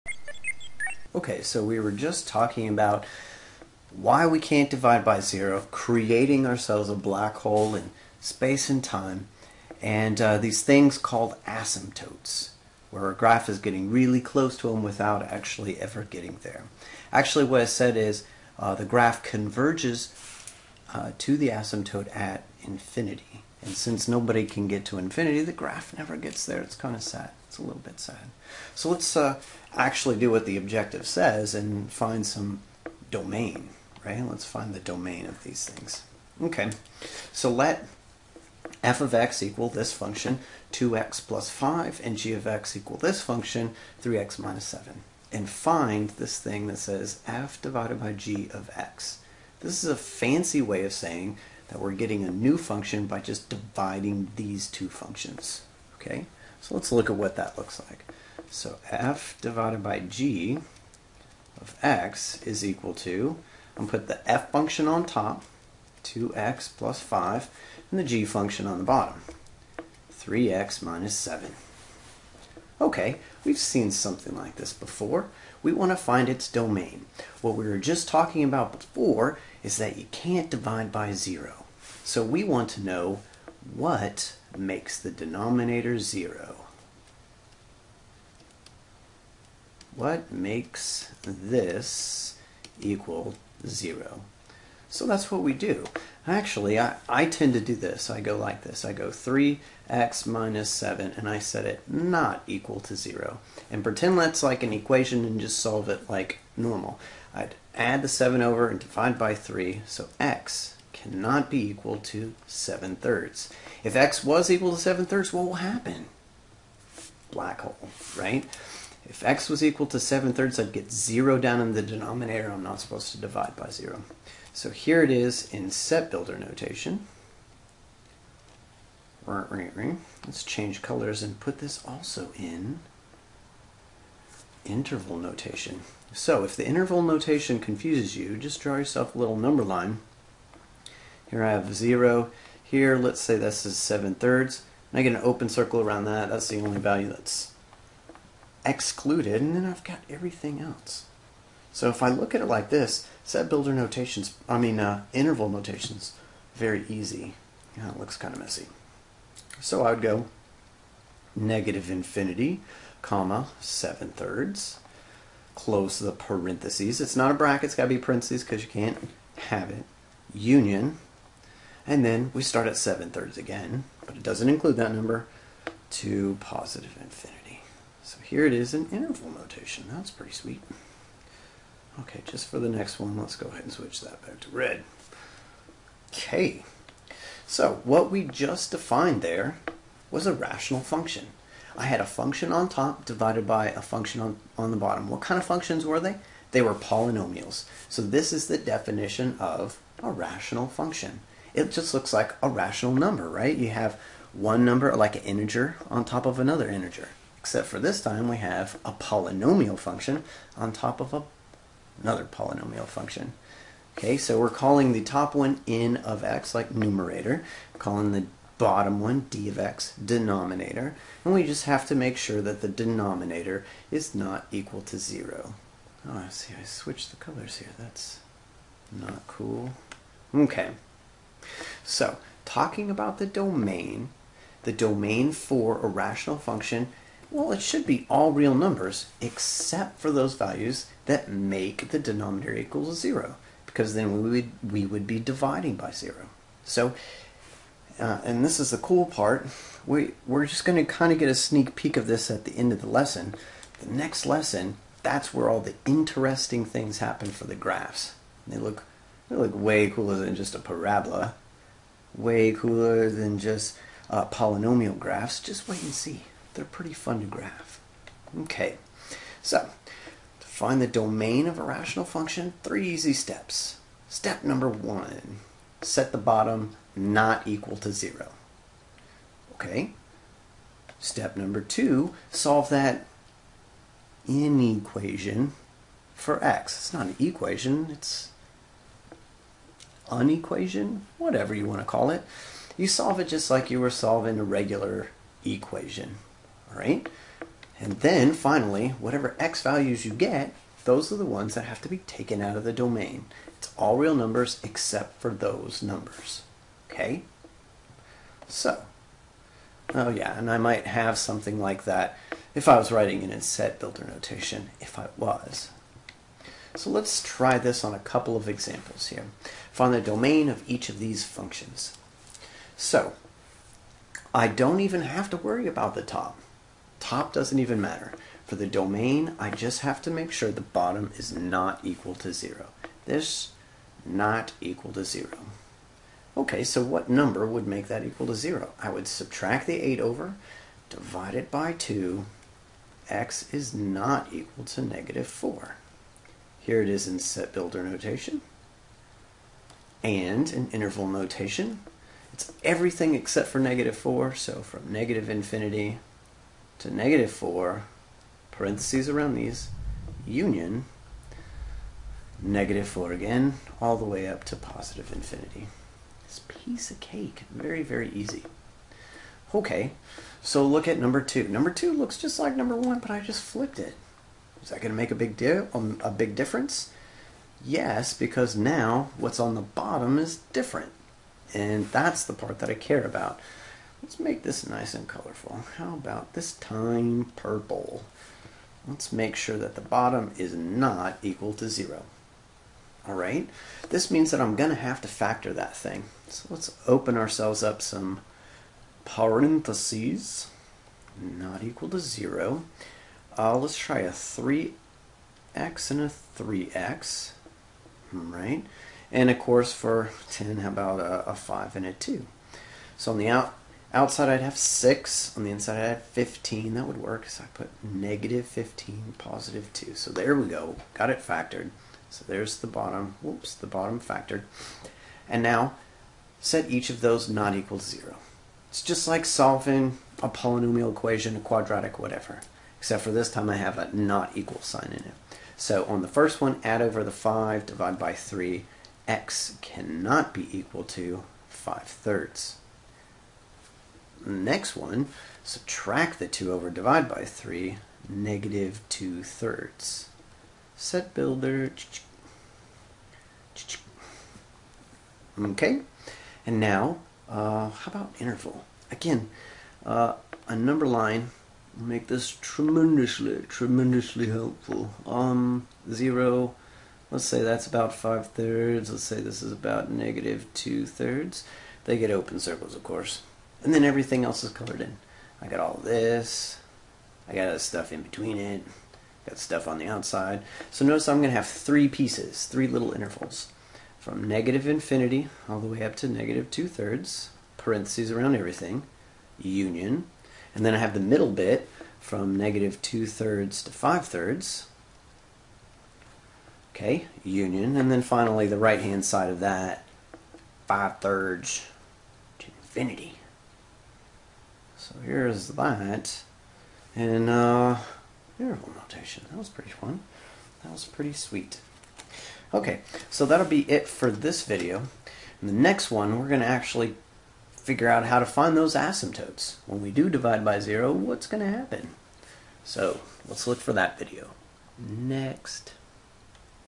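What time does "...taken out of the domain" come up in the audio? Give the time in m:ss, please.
5:01.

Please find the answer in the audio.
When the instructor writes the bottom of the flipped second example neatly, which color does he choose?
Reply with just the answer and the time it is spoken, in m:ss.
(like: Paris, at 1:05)
Purple, at 6:27.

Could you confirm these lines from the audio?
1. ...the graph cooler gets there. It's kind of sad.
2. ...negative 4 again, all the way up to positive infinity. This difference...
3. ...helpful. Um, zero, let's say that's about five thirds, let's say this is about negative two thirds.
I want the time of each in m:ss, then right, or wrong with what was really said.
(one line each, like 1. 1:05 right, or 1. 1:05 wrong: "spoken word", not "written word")
1. 0:25 wrong: "never", not "cooler"
2. 6:02 wrong: "piece", not "difference"
3. 7:44 right.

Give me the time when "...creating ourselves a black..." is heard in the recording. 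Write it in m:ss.
0:05.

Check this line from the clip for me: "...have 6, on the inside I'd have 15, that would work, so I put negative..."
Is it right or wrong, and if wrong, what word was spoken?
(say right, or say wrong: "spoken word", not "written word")
right.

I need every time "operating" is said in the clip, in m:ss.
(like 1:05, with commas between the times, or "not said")
not said.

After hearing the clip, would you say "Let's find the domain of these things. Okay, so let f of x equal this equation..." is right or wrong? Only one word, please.
wrong.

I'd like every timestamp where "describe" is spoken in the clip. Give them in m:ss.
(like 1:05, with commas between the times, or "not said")
not said.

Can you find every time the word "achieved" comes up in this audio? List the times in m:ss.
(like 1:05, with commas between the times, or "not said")
not said.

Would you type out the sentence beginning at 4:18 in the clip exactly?
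They look, they look way cooler than just a parabola way cooler than just uh, polynomial graphs.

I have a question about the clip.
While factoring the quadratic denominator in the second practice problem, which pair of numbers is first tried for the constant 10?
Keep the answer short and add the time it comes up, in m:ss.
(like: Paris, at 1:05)
5 and 2, at 6:51.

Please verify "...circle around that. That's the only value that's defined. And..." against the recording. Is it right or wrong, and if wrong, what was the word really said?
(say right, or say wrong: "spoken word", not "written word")
wrong: "excluded", not "defined".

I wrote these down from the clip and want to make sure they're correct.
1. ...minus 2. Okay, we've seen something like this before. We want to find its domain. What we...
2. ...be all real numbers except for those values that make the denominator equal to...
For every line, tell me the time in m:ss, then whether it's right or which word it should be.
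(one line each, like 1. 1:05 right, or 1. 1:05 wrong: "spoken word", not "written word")
1. 1:10 wrong: "7", not "2"
2. 3:57 right.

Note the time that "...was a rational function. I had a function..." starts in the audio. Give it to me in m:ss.
3:10.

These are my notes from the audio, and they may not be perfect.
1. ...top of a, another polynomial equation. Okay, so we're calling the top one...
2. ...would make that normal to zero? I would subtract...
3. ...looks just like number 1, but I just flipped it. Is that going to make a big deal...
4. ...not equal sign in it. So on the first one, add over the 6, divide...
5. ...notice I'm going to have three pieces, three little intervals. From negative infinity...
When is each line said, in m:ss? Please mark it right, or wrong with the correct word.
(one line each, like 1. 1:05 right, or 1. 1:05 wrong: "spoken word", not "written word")
1. 3:30 wrong: "function", not "equation"
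2. 5:37 wrong: "equal", not "normal"
3. 6:11 right
4. 7:13 wrong: "5", not "6"
5. 8:00 right.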